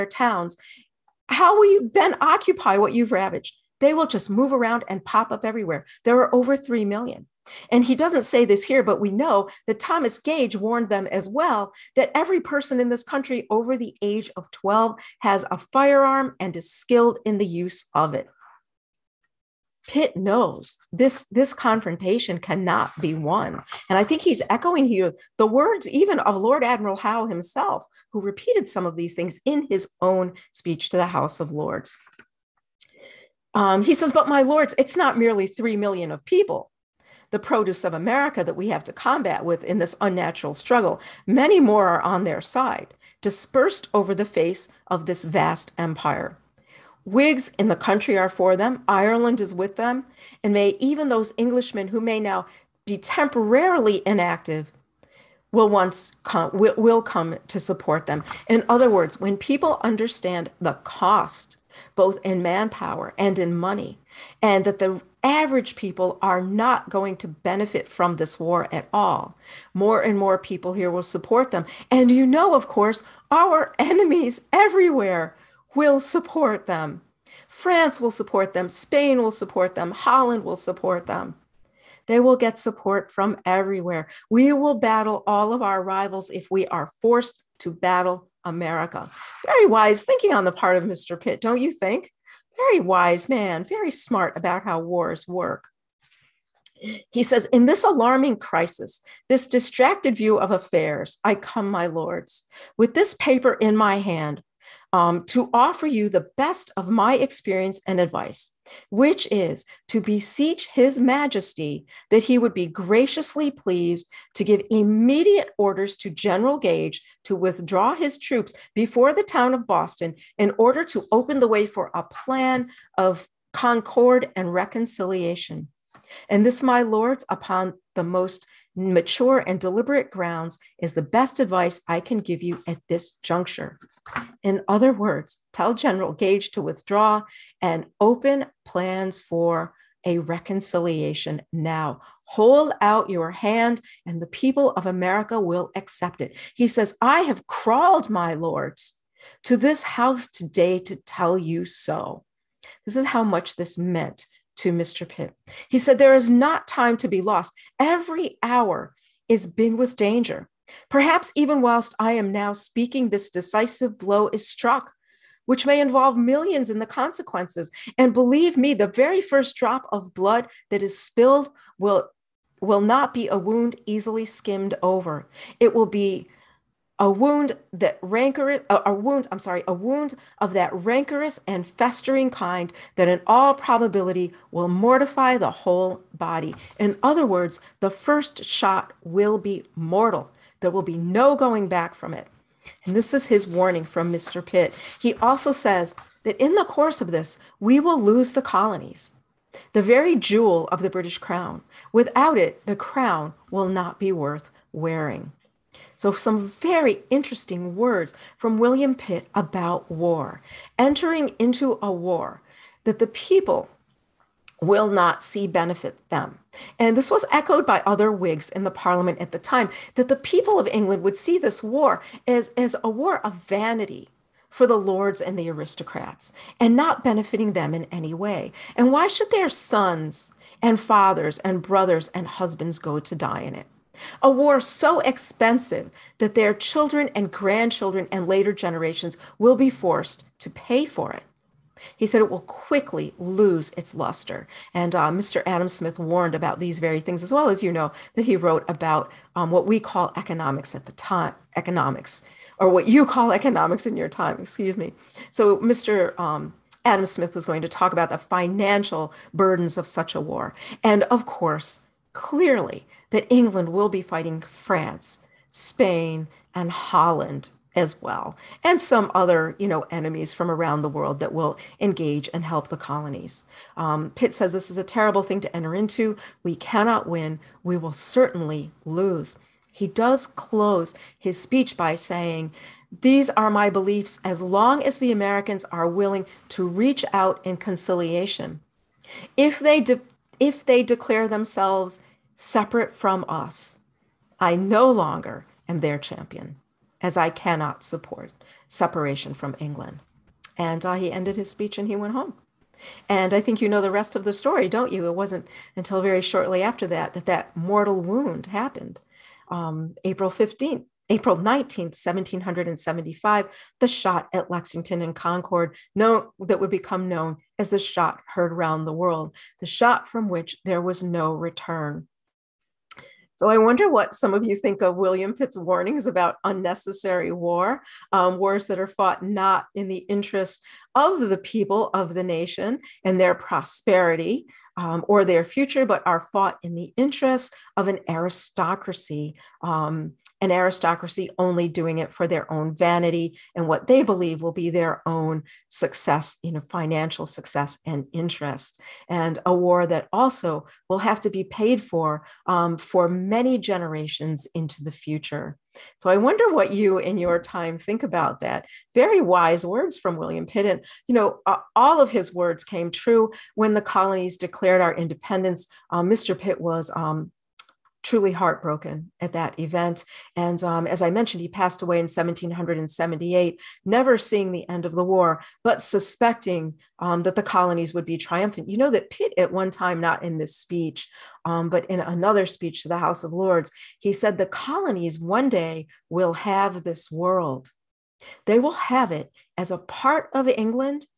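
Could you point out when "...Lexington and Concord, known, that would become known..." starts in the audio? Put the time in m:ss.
5:14.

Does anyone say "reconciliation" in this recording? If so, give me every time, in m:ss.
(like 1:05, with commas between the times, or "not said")
2:04, 2:20.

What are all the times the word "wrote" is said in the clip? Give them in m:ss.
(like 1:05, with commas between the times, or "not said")
4:08.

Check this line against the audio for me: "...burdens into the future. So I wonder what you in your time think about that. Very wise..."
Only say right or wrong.
wrong.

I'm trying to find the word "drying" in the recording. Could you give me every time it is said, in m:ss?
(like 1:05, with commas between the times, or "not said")
not said.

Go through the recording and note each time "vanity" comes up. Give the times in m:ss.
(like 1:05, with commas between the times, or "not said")
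3:43, 5:42.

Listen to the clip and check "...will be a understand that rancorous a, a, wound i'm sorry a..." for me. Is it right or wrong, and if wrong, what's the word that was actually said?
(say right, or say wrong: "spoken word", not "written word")
wrong: "wound", not "understand".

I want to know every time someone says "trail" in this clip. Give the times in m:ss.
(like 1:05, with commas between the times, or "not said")
not said.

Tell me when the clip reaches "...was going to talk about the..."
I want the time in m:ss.
4:17.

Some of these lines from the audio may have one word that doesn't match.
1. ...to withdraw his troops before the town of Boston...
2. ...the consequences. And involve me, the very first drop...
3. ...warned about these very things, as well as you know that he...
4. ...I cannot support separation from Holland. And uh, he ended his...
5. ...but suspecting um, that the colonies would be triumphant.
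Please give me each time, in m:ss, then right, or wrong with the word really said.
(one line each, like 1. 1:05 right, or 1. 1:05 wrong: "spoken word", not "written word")
1. 1:57 right
2. 2:46 wrong: "believe", not "involve"
3. 4:05 right
4. 4:57 wrong: "England", not "Holland"
5. 6:15 right.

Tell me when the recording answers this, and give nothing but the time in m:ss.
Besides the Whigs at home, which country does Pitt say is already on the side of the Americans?
0:48.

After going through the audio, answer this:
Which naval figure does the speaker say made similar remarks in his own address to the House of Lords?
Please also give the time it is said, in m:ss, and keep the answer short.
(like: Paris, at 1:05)
Lord Admiral Howe, at 0:26.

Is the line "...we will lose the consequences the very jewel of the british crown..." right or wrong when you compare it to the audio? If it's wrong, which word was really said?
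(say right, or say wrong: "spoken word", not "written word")
wrong: "colonies", not "consequences".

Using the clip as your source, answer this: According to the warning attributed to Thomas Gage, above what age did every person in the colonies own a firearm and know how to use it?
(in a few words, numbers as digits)
12.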